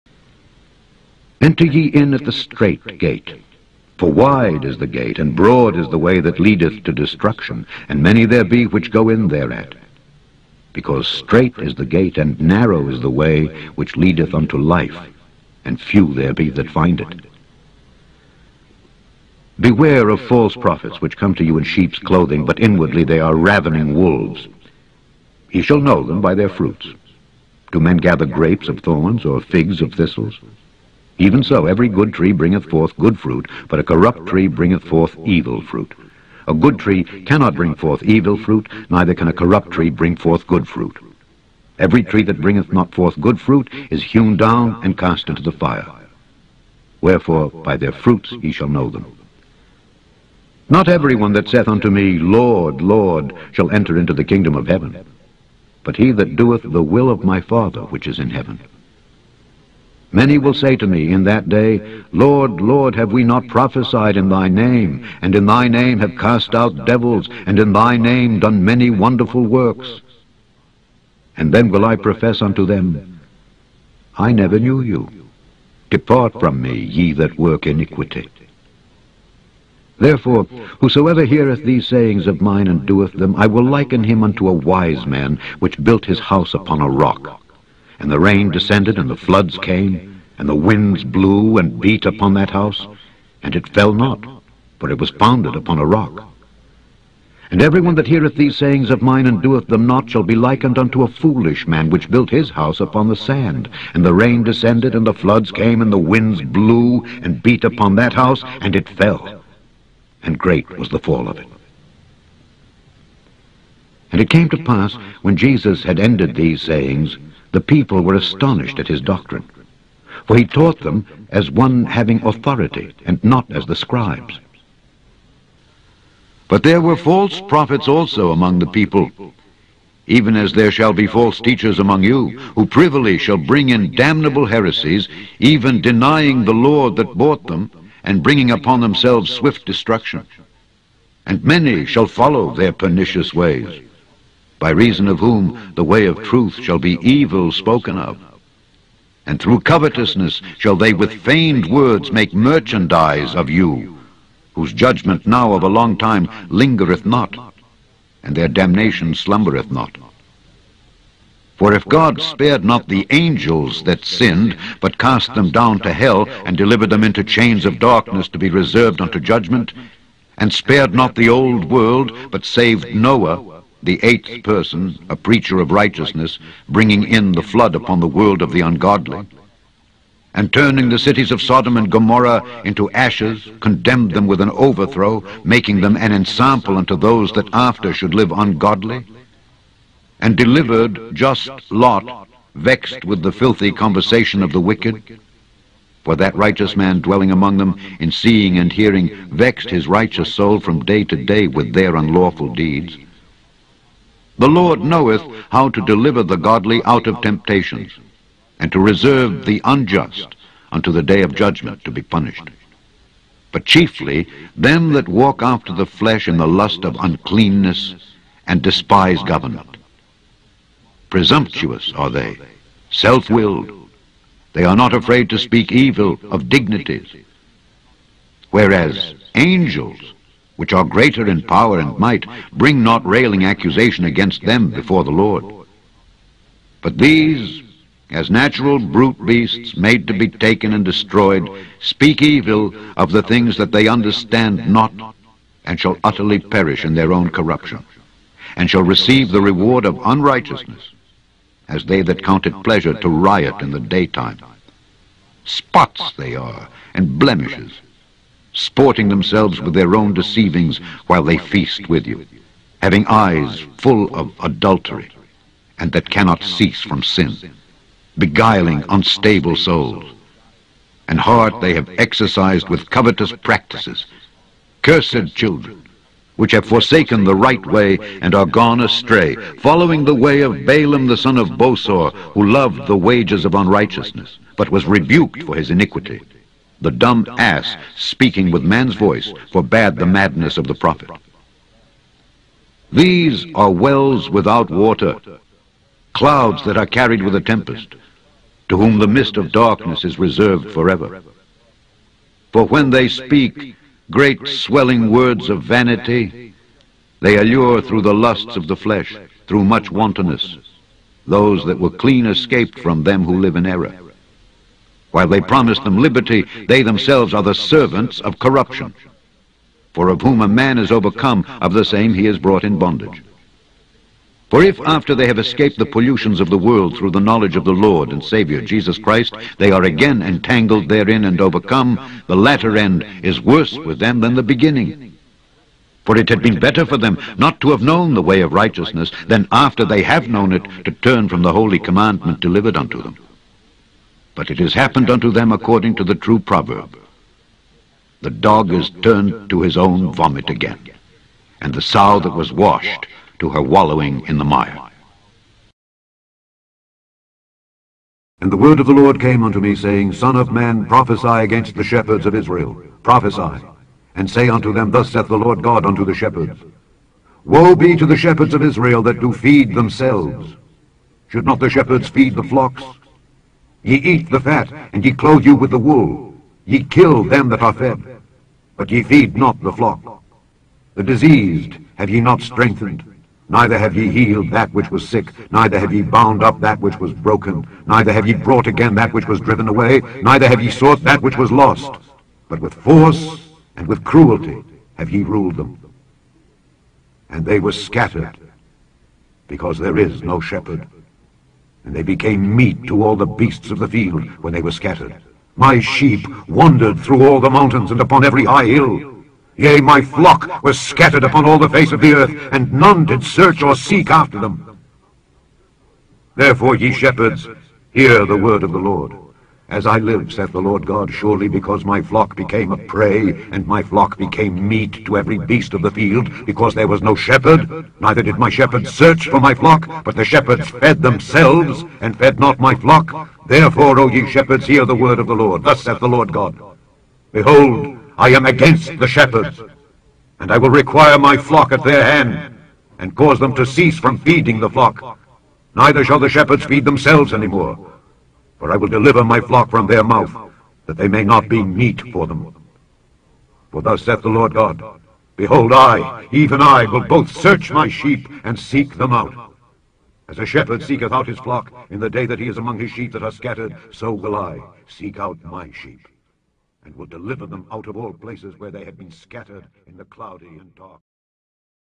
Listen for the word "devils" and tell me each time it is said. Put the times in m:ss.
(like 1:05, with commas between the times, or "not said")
1:06.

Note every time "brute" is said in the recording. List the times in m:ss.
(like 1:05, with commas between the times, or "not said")
3:58.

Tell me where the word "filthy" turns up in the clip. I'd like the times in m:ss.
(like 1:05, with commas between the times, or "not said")
3:13.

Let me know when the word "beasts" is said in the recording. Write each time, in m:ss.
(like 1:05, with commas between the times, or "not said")
3:59, 6:43, 7:05.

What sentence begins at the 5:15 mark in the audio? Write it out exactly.
While they promise them liberty, they themselves are the servants of corruption.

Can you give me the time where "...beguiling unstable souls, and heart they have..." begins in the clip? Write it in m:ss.
4:28.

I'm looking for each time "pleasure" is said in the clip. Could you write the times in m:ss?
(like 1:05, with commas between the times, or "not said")
4:12.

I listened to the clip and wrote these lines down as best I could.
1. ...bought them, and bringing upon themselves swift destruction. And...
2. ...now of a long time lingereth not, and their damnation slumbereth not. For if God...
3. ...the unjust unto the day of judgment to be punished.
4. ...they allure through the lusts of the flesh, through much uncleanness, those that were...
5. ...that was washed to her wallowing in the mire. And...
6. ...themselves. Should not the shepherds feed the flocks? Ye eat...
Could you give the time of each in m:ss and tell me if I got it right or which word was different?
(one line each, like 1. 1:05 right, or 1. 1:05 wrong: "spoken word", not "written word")
1. 2:17 right
2. 2:35 right
3. 3:29 right
4. 5:07 wrong: "wantonness", not "uncleanness"
5. 5:52 right
6. 6:09 right.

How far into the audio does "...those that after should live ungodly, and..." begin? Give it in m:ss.
3:06.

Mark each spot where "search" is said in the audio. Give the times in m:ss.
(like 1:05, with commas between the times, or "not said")
6:53, 7:08, 7:37.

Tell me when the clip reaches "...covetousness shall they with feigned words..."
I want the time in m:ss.
2:29.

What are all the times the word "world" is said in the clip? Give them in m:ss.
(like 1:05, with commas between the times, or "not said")
2:51, 2:58, 5:26.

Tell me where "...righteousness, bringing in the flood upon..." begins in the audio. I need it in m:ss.
2:55.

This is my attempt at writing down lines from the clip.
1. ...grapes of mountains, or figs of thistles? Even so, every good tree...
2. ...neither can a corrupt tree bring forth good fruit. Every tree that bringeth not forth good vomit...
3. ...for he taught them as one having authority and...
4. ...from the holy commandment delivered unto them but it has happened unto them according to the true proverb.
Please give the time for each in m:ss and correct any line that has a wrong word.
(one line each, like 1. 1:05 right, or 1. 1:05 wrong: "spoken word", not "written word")
1. 0:28 wrong: "thorns", not "mountains"
2. 0:38 wrong: "fruit", not "vomit"
3. 2:00 right
4. 5:41 right.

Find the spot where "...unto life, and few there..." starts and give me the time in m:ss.
0:14.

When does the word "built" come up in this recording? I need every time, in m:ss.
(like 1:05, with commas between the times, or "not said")
1:25, 1:42.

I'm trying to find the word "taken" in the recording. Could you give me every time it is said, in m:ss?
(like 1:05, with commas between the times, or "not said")
4:00.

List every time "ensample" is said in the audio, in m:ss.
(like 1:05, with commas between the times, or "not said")
3:06.